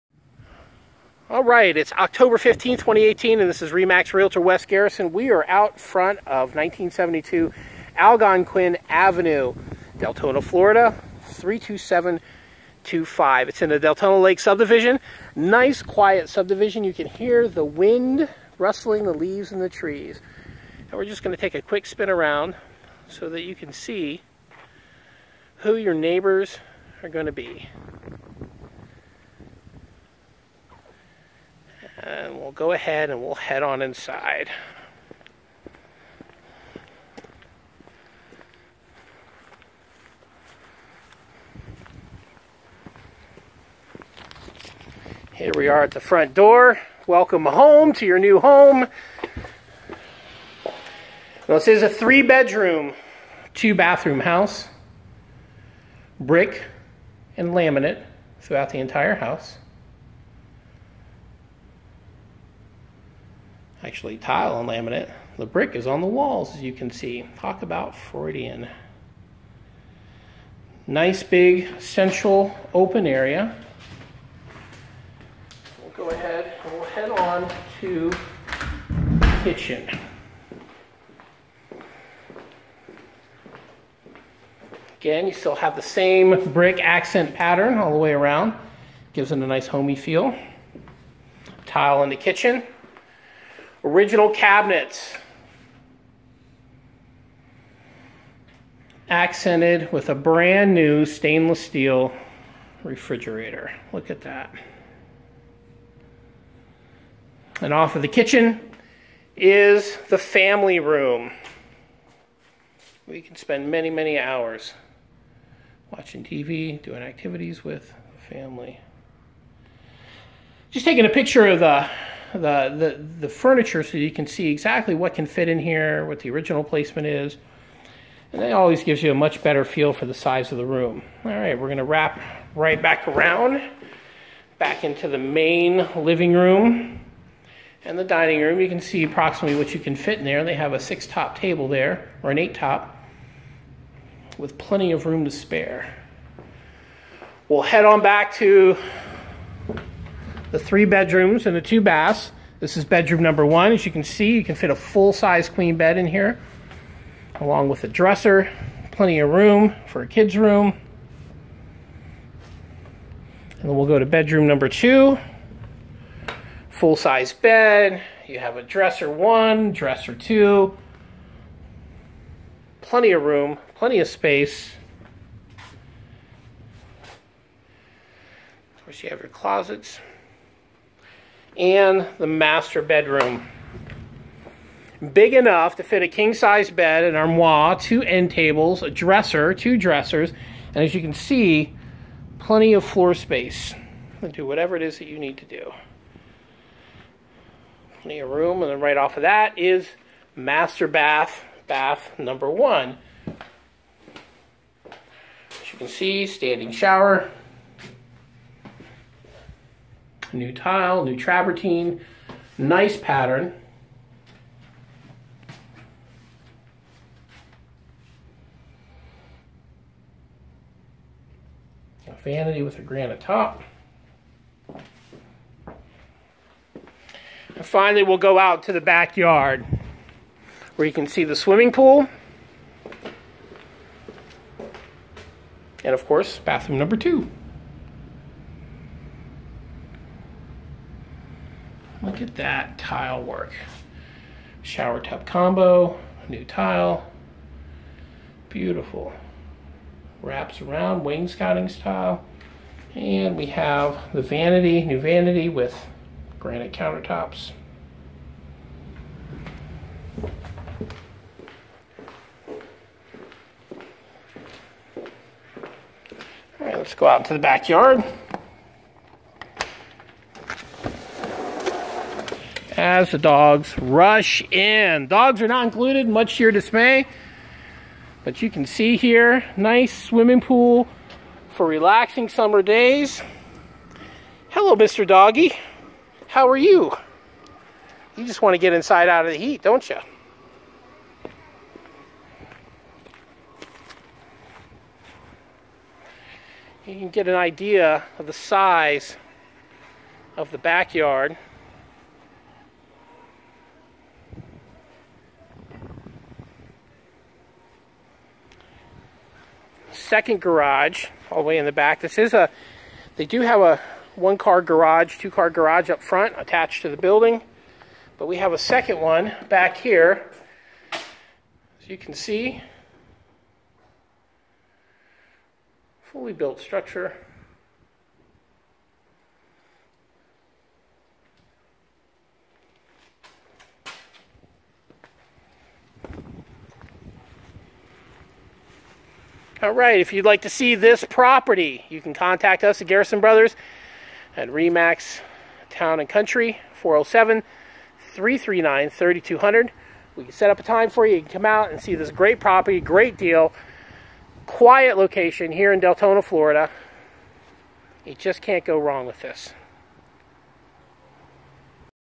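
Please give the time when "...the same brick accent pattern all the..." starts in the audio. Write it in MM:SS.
01:25.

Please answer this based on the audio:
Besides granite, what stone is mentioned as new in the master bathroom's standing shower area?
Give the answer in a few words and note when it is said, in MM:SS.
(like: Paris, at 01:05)
Travertine, at 03:31.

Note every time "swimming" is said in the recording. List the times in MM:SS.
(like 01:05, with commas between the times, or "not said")
03:51, 04:40.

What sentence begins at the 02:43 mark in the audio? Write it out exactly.
And then we'll go to bedroom number two.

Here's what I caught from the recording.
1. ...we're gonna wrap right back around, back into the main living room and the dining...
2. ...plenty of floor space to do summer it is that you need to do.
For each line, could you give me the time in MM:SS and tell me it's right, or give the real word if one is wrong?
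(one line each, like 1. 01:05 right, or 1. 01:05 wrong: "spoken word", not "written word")
1. 02:11 right
2. 03:12 wrong: "whatever", not "summer".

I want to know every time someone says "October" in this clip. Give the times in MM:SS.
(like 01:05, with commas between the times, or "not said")
00:01.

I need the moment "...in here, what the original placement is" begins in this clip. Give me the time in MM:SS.
02:05.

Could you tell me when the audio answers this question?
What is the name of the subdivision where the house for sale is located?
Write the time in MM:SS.
00:13.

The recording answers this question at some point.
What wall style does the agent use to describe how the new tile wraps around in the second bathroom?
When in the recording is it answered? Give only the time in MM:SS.
04:11.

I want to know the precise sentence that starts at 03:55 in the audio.
And of course, bathroom number two.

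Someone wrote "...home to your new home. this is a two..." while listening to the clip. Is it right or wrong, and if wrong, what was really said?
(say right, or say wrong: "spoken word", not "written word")
wrong: "three", not "two".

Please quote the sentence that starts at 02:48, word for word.
You have a dresser one, dresser two.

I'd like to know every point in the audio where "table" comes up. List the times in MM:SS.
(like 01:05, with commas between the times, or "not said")
02:21, 03:08.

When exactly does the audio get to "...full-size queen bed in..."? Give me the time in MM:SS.
02:34.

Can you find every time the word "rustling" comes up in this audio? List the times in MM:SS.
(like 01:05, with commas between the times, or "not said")
00:18.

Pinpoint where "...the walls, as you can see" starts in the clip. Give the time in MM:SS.
01:06.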